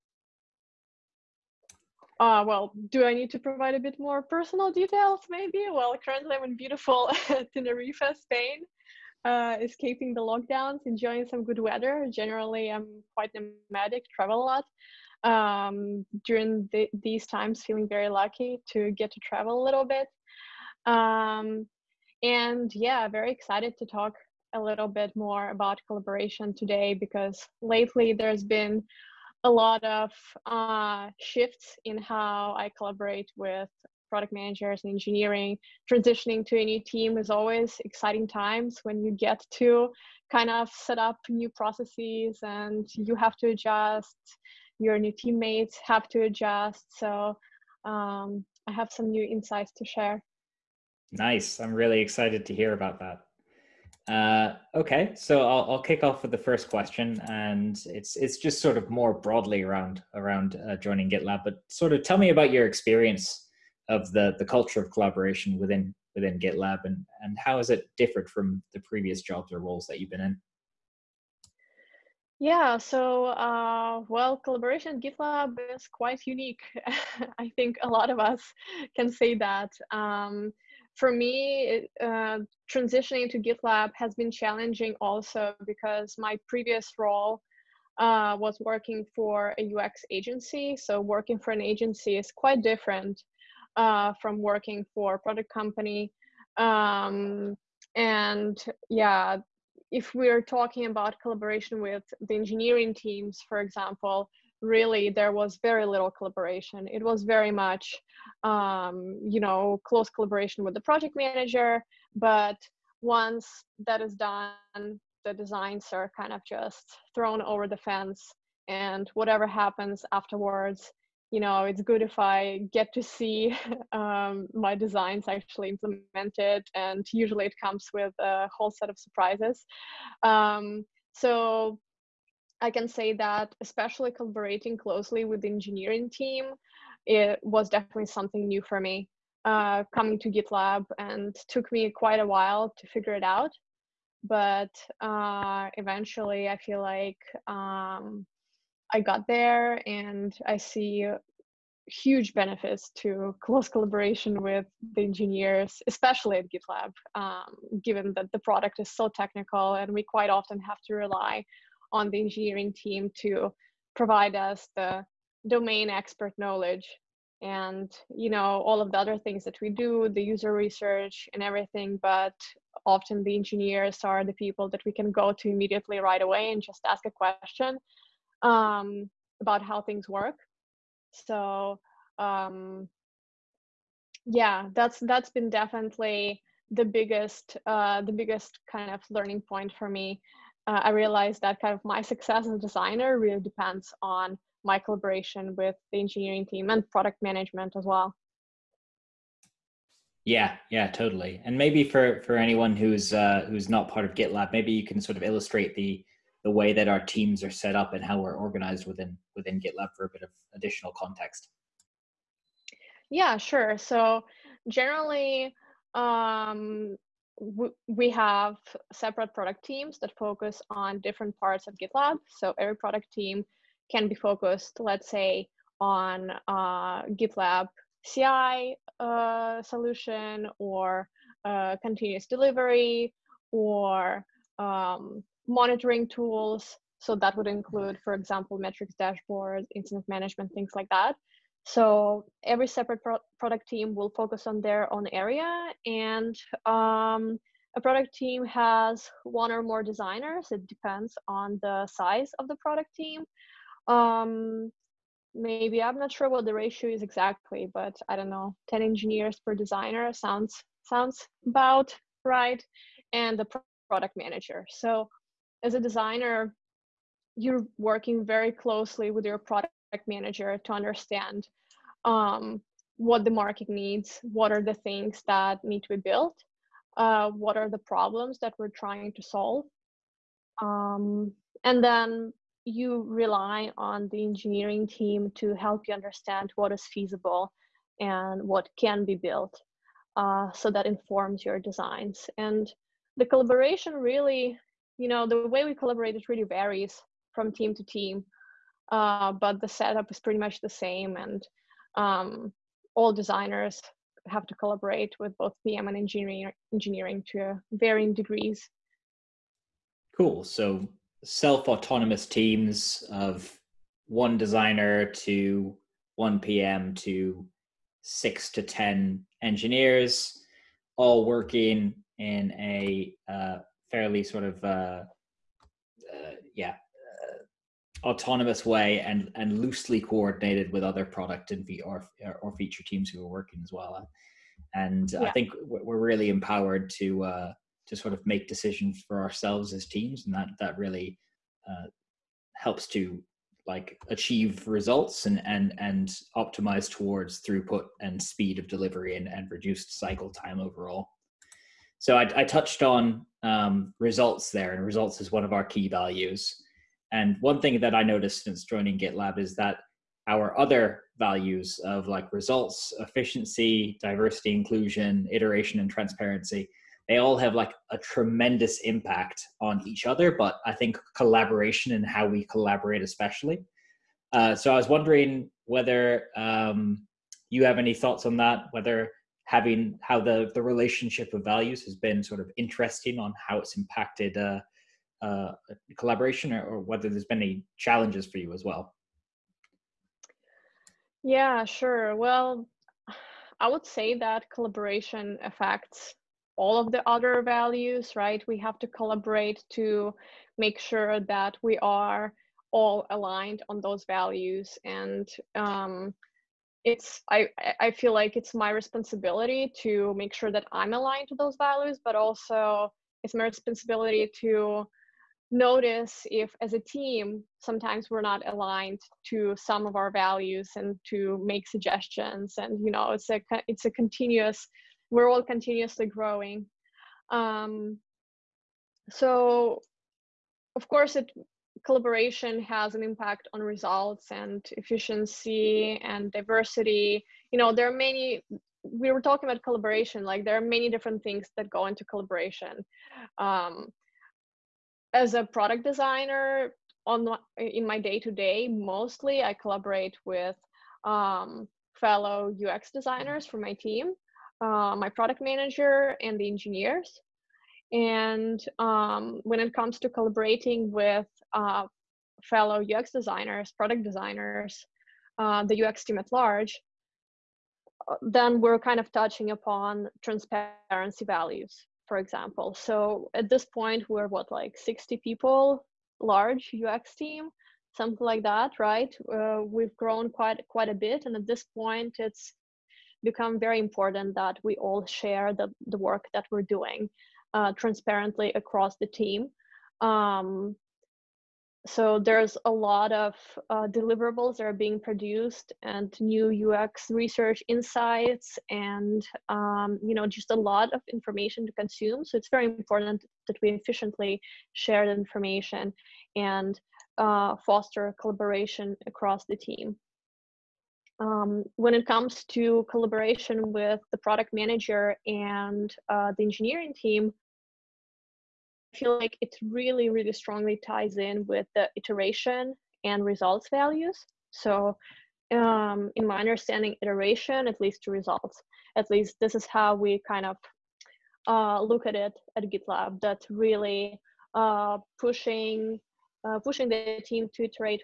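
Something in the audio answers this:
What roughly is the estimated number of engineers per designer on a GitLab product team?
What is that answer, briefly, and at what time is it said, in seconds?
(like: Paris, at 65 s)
10, at 258 s.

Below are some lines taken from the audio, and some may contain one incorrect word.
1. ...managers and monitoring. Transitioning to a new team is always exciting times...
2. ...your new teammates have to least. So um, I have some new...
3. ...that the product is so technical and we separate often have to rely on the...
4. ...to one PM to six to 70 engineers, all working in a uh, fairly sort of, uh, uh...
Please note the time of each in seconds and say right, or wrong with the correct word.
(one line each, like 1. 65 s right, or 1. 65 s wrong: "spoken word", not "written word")
1. 34 s wrong: "engineering", not "monitoring"
2. 44 s wrong: "adjust", not "least"
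3. 158 s wrong: "quite", not "separate"
4. 315 s wrong: "10", not "70".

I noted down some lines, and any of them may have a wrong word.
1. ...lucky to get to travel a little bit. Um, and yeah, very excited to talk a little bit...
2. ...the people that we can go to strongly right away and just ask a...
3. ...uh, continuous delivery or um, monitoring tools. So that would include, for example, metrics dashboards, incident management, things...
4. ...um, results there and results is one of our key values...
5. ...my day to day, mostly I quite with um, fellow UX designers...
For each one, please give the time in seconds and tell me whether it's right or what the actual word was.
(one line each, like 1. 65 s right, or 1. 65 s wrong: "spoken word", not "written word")
1. 18 s right
2. 174 s wrong: "immediately", not "strongly"
3. 231 s right
4. 353 s right
5. 447 s wrong: "collaborate", not "quite".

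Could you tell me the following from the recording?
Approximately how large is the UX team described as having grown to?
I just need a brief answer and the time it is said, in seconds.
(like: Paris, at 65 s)
60 people, at 474 s.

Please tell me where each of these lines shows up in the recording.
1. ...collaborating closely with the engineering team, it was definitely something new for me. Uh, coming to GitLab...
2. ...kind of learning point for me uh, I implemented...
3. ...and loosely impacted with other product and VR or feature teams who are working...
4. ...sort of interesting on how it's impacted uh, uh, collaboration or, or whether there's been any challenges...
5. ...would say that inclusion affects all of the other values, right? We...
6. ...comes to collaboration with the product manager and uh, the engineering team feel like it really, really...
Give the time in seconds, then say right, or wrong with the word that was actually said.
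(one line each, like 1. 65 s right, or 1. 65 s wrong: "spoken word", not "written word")
1. 134 s right
2. 188 s wrong: "realized", not "implemented"
3. 329 s wrong: "coordinated", not "impacted"
4. 382 s right
5. 393 s wrong: "collaboration", not "inclusion"
6. 512 s right.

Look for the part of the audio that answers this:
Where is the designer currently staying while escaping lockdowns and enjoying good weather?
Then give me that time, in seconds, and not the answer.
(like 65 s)
7 s.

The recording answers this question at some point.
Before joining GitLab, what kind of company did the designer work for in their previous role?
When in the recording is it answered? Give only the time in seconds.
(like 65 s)
89 s.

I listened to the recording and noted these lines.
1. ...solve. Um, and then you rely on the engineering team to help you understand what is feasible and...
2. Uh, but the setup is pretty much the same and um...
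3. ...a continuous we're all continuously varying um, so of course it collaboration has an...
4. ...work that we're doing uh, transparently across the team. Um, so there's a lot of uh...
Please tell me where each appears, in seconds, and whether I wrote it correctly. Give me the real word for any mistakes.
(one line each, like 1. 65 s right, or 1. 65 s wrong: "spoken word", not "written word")
1. 279 s right
2. 298 s right
3. 423 s wrong: "growing", not "varying"
4. 485 s right.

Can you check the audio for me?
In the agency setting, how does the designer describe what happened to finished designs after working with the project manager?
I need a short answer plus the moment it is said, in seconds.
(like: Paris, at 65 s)
thrown over the fence, at 117 s.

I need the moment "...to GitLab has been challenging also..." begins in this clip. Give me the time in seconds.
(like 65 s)
83 s.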